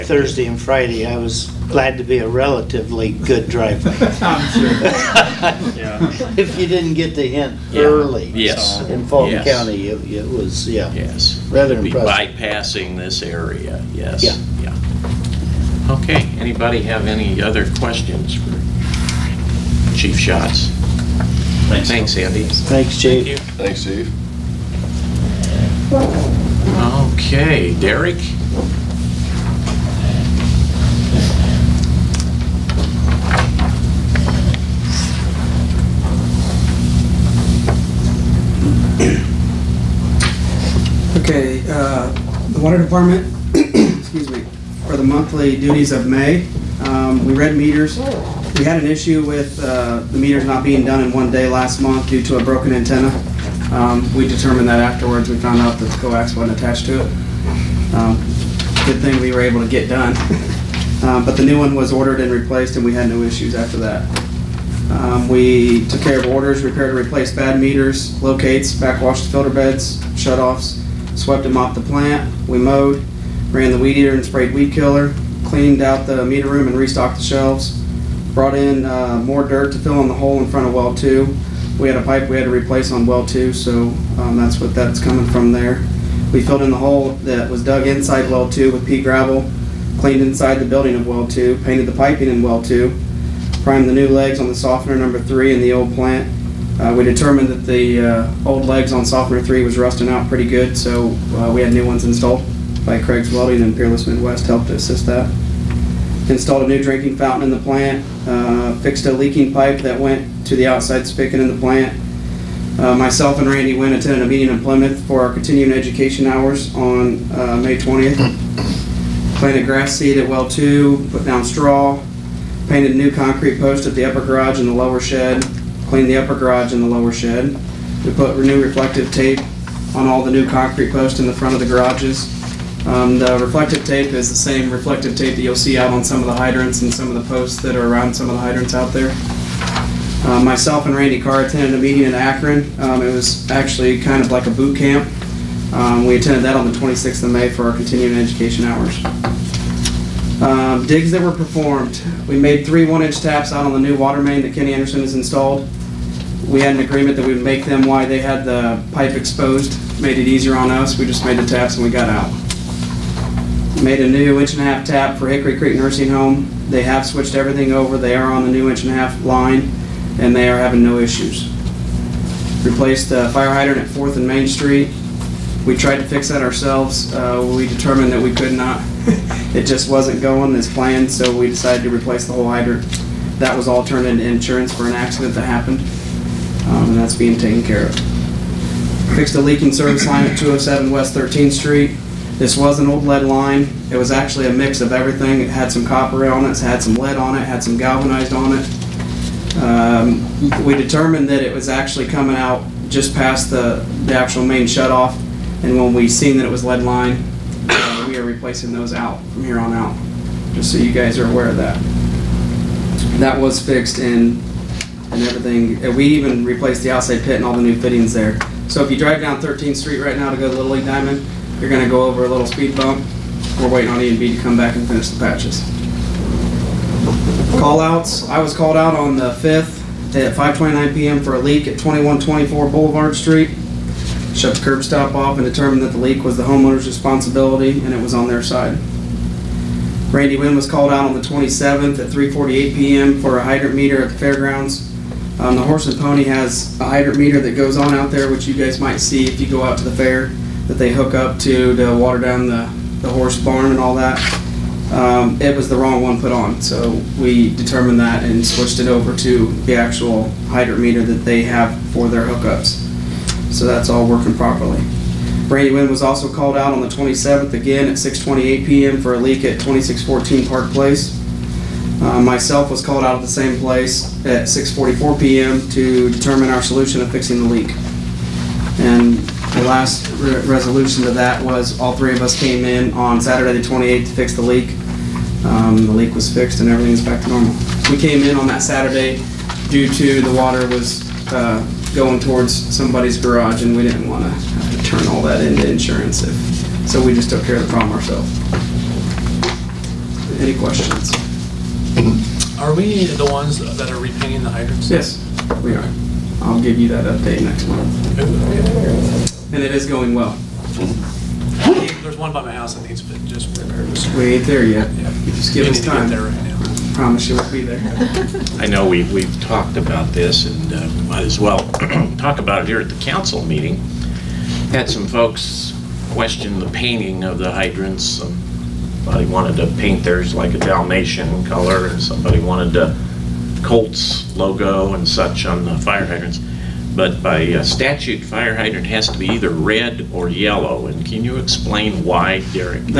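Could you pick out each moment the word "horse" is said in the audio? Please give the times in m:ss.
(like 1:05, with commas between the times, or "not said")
4:05, 4:13.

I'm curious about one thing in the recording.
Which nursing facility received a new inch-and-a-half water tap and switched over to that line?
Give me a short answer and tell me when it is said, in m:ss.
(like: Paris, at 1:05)
Hickory Creek Nursing Home, at 2:45.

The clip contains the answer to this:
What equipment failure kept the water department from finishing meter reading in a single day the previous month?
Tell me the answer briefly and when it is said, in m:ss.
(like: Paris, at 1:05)
Broken antenna, at 0:52.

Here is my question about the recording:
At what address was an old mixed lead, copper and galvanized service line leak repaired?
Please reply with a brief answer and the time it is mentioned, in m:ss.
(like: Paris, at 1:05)
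207 West 13th Street, at 3:10.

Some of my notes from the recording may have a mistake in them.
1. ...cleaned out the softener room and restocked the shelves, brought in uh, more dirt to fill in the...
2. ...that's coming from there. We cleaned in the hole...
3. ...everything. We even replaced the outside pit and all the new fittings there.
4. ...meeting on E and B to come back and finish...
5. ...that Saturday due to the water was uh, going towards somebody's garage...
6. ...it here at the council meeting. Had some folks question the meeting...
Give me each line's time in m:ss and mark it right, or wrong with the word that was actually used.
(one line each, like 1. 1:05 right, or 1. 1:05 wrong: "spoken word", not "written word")
1. 1:15 wrong: "meter", not "softener"
2. 1:24 wrong: "filled", not "cleaned"
3. 3:35 right
4. 3:43 wrong: "waiting", not "meeting"
5. 4:48 right
6. 5:22 wrong: "painting", not "meeting".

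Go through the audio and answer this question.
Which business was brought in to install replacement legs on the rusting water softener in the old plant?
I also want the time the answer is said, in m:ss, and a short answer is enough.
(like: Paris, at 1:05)
Craig's Welding, at 1:43.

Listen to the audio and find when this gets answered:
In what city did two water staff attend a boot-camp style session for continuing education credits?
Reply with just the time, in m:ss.
2:22.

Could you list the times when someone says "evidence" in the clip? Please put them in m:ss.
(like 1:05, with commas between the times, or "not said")
not said.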